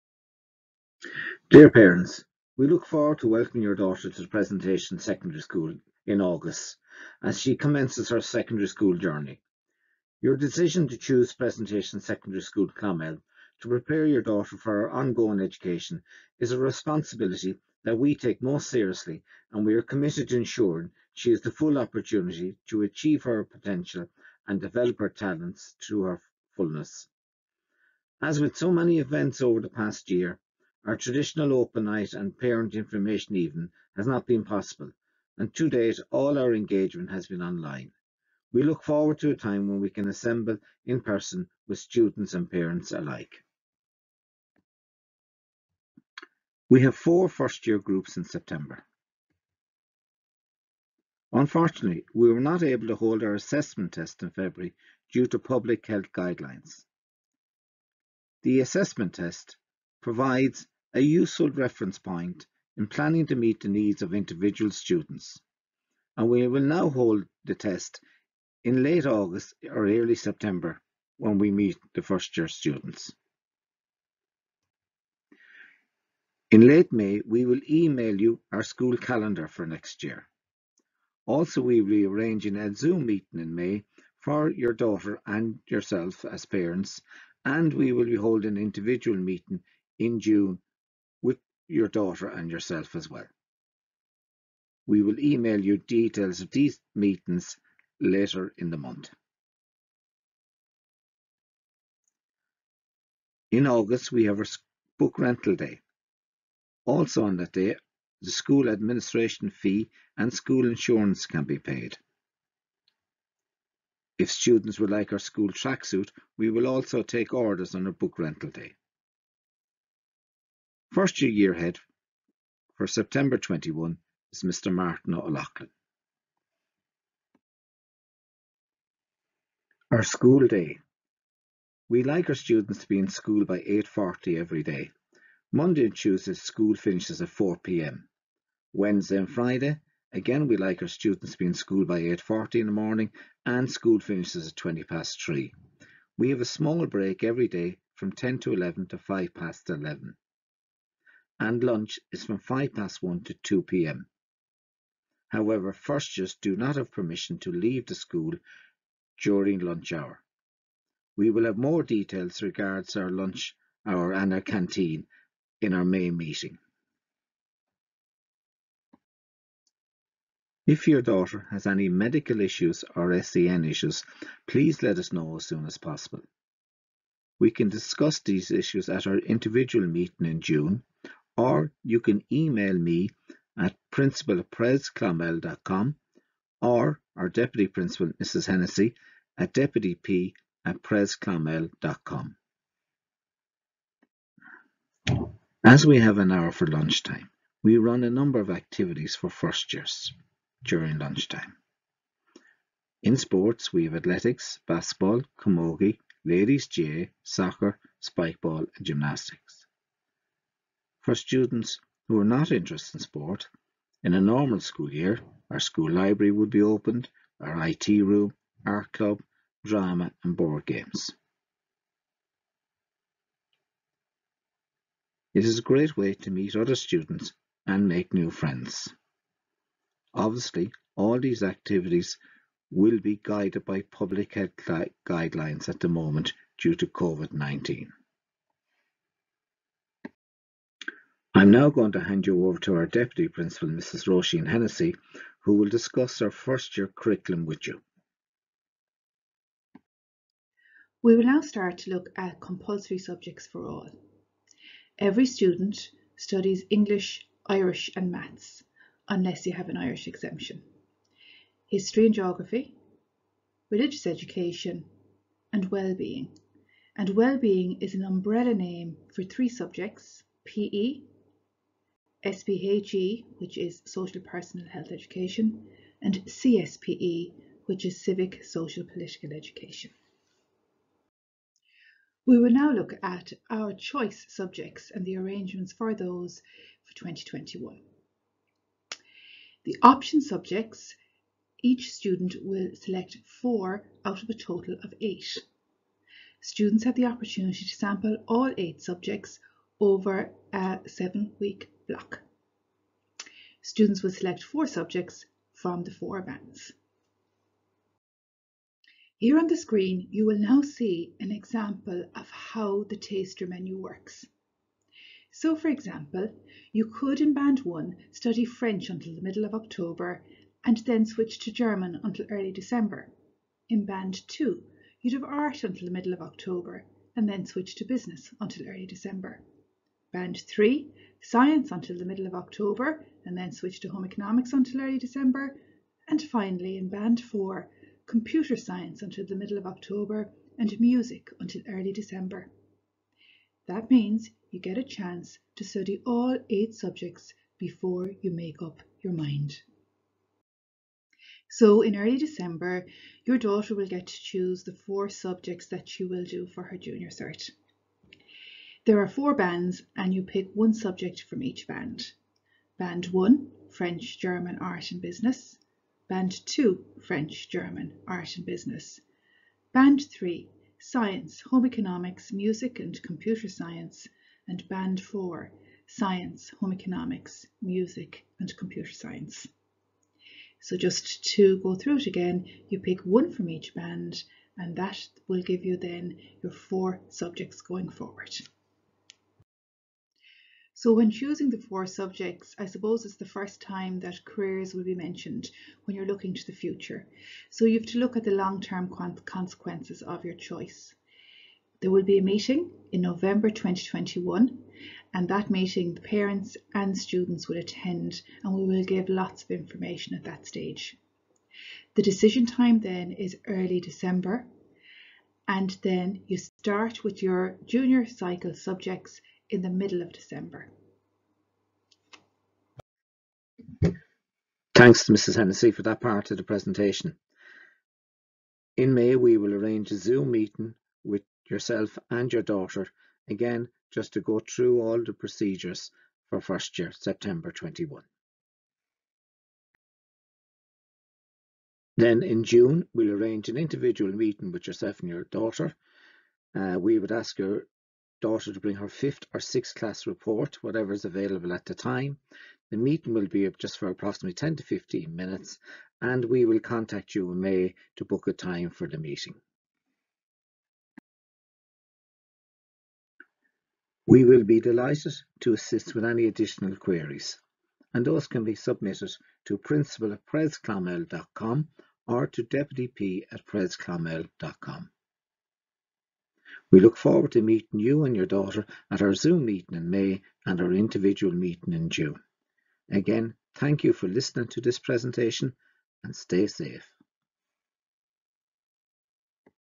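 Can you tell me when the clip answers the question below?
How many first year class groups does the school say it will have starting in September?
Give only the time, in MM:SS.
00:46.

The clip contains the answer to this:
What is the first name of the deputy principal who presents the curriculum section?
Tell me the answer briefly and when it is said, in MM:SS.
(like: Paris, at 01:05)
Roisin, at 04:04.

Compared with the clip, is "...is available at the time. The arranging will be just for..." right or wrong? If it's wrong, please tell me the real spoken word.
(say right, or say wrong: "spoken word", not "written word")
wrong: "meeting", not "arranging".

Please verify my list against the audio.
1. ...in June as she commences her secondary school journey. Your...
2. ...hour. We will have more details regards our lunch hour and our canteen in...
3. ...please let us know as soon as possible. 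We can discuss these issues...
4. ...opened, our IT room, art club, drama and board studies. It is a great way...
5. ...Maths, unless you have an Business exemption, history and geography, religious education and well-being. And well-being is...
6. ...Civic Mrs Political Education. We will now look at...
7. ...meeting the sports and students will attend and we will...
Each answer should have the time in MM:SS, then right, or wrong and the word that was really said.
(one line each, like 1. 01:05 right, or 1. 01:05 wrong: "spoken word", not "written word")
1. 00:06 wrong: "August", not "June"
2. 02:39 right
3. 02:54 right
4. 03:36 wrong: "games", not "studies"
5. 04:18 wrong: "Irish", not "Business"
6. 04:38 wrong: "Social", not "Mrs"
7. 06:45 wrong: "parents", not "sports".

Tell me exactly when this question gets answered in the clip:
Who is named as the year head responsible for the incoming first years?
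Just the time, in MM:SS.
02:04.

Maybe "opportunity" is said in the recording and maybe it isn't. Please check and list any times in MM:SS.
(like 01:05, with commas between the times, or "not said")
00:21, 04:57.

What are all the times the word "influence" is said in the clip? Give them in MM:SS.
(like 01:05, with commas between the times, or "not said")
not said.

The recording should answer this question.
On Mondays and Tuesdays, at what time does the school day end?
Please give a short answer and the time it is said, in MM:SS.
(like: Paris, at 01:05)
4pm, at 02:17.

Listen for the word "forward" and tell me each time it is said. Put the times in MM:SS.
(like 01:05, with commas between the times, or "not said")
00:02, 00:38, 06:27, 07:56.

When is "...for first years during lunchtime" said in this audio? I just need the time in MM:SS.
03:19.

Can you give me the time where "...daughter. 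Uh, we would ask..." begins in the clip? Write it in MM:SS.
07:25.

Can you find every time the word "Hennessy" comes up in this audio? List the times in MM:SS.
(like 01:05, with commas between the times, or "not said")
03:08, 04:04, 07:05.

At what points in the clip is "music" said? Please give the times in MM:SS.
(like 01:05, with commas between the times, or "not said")
05:40, 06:12, 06:17.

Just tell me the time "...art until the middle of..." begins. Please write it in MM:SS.
05:25.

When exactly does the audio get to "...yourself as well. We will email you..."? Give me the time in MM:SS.
01:32.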